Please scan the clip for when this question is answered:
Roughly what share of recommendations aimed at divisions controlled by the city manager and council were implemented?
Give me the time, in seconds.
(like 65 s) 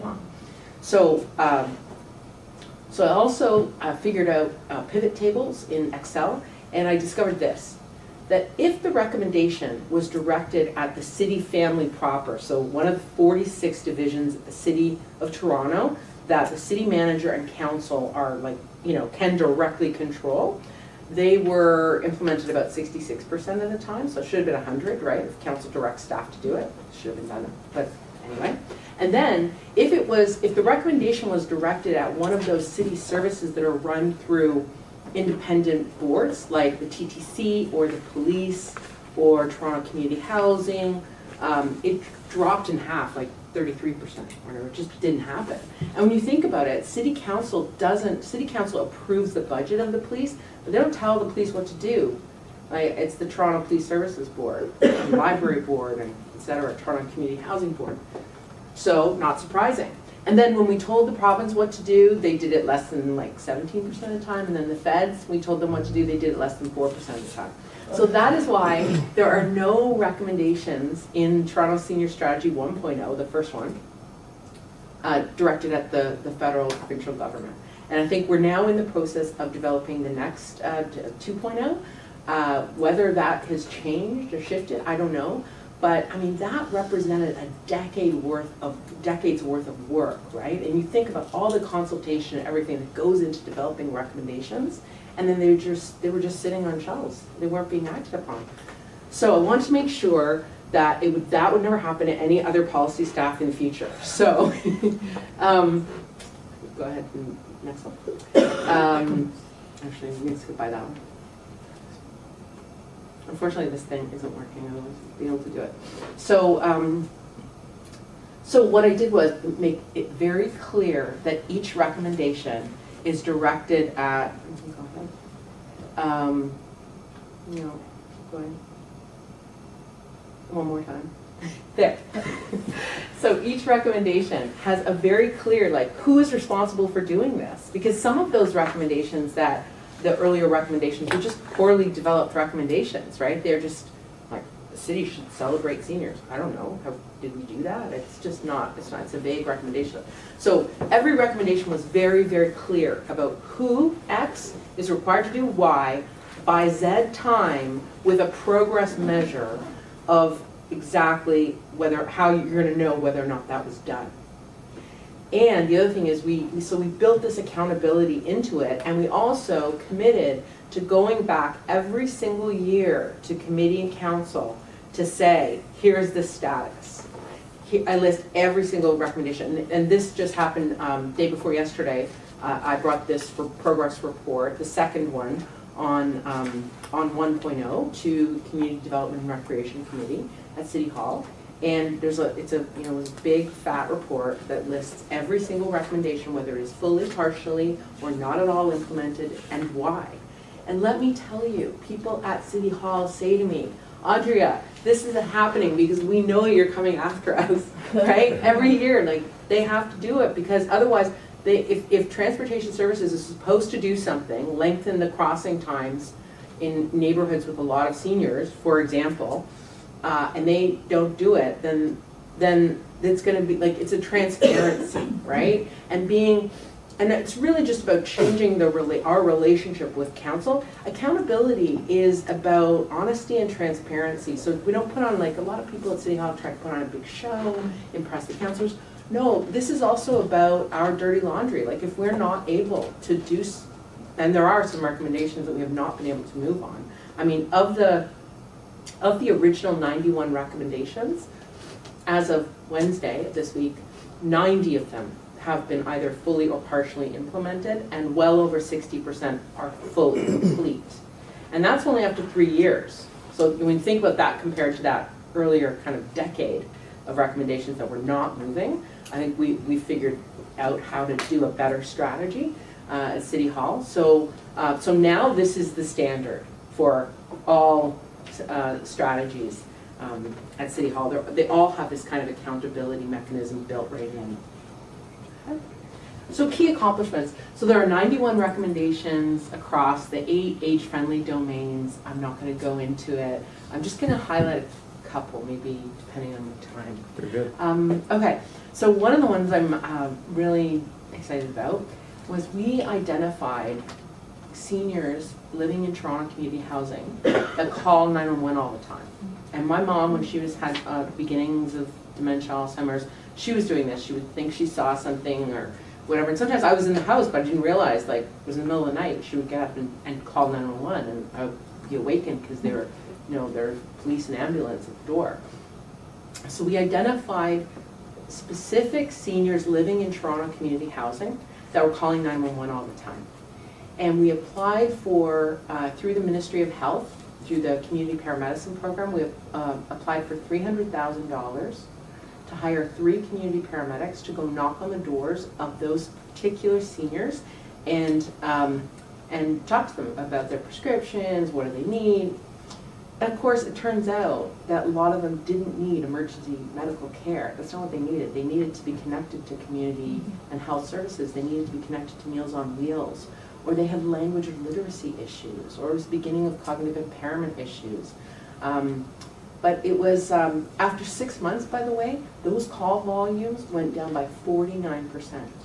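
22 s.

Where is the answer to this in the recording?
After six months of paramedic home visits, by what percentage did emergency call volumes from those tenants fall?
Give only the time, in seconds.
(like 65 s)
374 s.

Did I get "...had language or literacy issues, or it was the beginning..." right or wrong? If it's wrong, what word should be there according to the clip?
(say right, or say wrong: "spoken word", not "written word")
right.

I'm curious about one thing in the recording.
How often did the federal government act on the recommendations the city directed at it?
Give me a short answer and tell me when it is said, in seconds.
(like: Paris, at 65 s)
less than 4%, at 66 s.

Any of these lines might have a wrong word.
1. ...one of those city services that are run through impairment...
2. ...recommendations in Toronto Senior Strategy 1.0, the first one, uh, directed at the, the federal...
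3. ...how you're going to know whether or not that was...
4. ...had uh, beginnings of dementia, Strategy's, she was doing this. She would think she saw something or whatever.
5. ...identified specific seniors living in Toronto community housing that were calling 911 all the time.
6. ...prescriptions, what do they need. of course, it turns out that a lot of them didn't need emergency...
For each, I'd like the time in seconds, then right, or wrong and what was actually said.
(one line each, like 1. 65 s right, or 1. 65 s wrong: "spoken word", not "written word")
1. 32 s wrong: "independent", not "impairment"
2. 69 s right
3. 162 s right
4. 310 s wrong: "Alzheimer", not "Strategy"
5. 326 s right
6. 350 s right.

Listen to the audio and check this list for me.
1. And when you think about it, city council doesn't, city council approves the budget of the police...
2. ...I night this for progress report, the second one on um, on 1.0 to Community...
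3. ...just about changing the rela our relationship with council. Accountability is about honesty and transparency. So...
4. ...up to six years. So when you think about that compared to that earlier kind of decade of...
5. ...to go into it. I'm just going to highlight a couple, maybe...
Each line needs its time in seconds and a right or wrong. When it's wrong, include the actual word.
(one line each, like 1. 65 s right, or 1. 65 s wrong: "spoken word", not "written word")
1. 45 s right
2. 182 s wrong: "brought", not "night"
3. 227 s right
4. 262 s wrong: "three", not "six"
5. 292 s right.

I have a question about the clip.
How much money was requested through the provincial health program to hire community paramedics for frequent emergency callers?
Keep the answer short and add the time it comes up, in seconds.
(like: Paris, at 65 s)
$300,000, at 340 s.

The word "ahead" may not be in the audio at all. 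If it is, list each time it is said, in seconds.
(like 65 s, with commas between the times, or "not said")
106 s, 128 s.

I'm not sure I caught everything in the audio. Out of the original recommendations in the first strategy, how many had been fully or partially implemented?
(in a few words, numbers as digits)
90.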